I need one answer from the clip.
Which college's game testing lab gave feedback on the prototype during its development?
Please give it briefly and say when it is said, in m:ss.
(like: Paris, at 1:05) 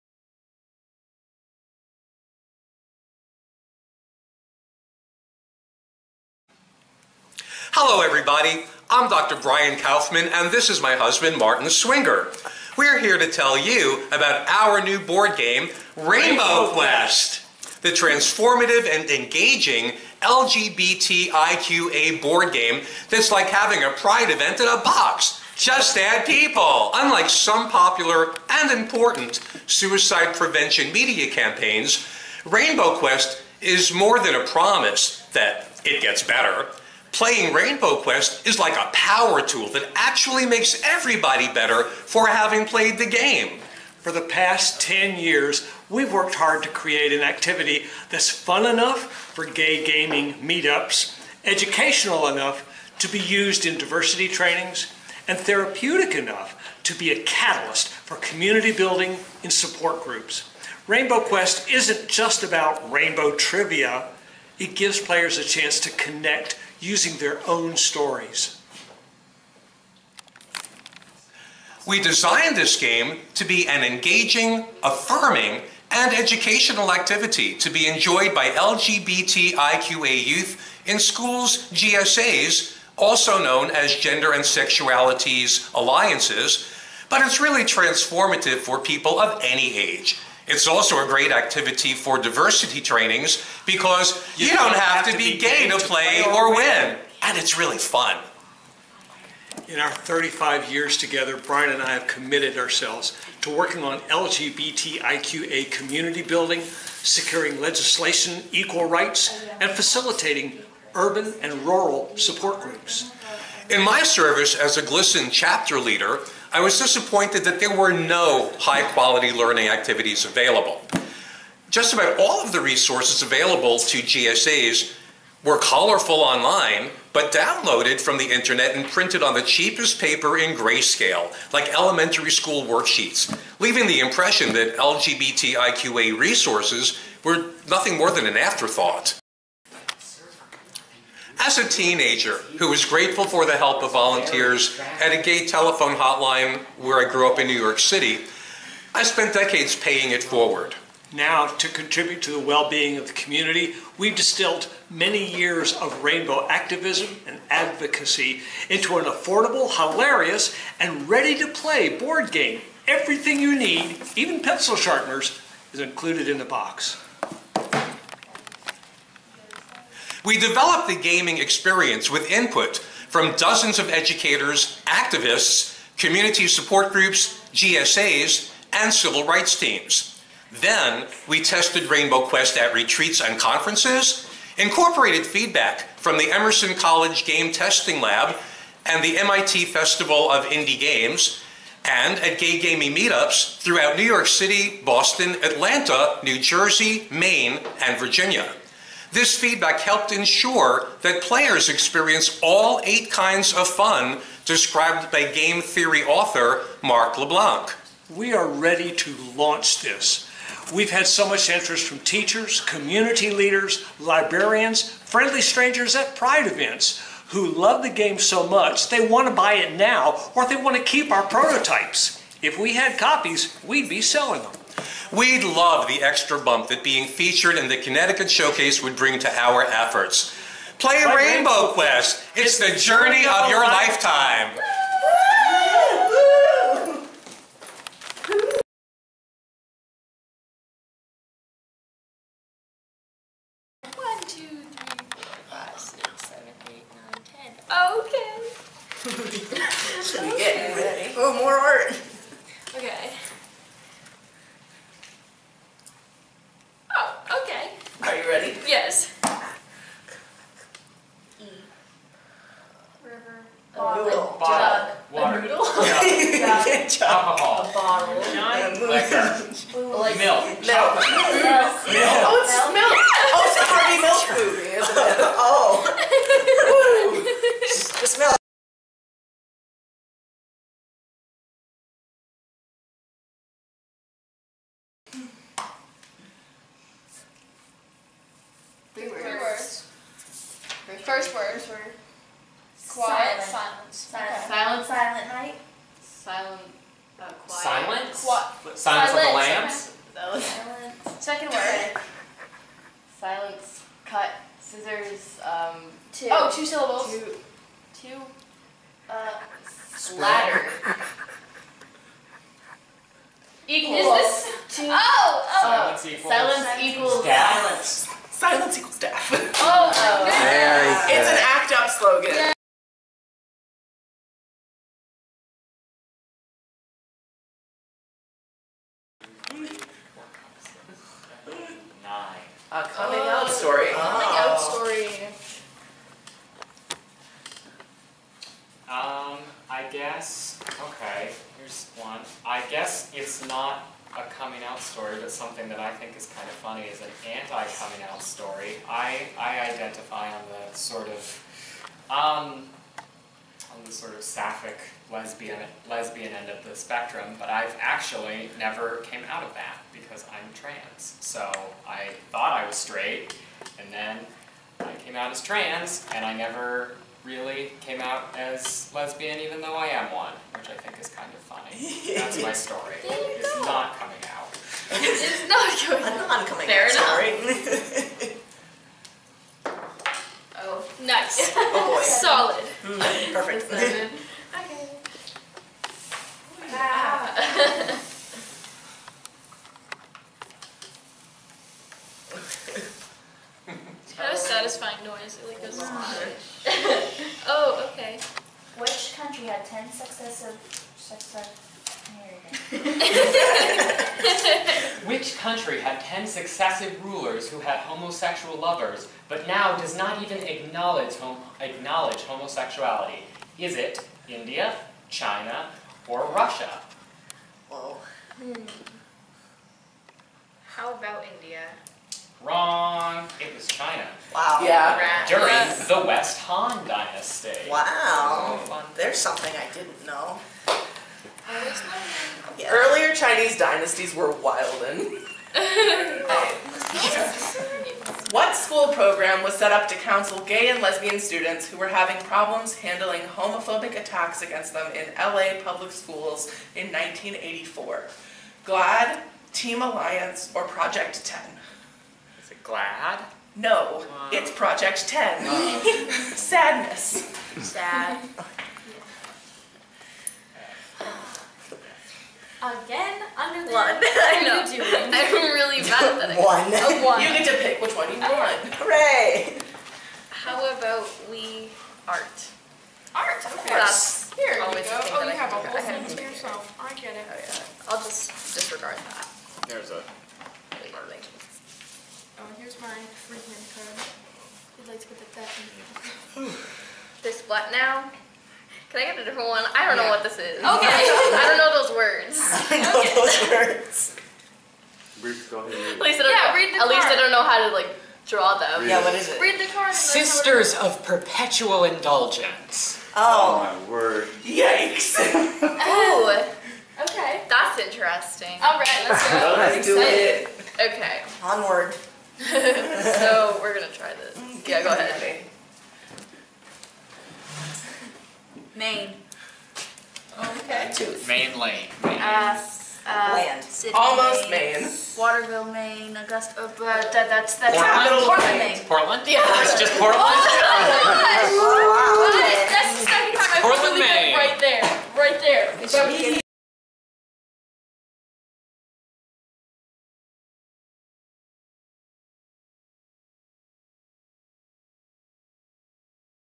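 Emerson College, at 3:06.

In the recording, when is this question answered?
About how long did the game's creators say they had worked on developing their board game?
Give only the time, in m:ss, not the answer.
0:44.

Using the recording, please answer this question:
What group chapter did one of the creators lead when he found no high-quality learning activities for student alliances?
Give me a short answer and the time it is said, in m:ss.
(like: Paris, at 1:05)
GLSEN, at 1:54.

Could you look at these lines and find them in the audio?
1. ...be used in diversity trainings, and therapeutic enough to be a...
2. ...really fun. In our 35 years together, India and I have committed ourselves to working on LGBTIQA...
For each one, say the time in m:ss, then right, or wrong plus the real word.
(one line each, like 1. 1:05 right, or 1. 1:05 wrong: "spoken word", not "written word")
1. 0:53 right
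2. 1:37 wrong: "Brian", not "India".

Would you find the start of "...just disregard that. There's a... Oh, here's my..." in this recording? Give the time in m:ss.
7:57.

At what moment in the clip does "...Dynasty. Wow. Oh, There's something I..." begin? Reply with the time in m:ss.
7:06.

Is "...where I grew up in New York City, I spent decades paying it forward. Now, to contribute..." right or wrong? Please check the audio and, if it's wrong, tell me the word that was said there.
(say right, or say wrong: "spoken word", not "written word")
right.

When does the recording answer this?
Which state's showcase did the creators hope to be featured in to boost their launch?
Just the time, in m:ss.
3:47.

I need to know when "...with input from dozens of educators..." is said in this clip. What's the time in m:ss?
2:52.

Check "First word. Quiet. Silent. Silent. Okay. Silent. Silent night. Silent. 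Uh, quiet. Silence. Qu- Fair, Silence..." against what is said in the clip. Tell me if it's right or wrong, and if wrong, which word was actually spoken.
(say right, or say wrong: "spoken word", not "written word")
wrong: "Silence", not "Fair".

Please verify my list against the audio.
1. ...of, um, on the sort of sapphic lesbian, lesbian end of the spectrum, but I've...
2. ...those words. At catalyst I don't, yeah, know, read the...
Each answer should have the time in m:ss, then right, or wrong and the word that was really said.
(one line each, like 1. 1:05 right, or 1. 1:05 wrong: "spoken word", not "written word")
1. 5:51 right
2. 8:13 wrong: "least", not "catalyst".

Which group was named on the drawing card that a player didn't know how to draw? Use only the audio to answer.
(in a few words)
Sisters of Perpetual Indulgence.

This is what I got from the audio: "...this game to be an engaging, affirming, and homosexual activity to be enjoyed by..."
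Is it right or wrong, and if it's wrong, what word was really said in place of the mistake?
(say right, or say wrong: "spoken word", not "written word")
wrong: "educational", not "homosexual".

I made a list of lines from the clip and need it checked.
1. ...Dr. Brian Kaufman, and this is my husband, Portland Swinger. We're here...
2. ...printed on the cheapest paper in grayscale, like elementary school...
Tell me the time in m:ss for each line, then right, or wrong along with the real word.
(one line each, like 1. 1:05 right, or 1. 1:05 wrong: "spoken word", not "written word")
1. 0:09 wrong: "Martin", not "Portland"
2. 2:08 right.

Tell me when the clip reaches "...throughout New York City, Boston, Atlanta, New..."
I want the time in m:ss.
3:13.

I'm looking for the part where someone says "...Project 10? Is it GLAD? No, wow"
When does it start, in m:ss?
7:30.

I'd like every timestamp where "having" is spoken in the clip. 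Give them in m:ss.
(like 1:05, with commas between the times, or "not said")
0:23, 0:42, 7:21.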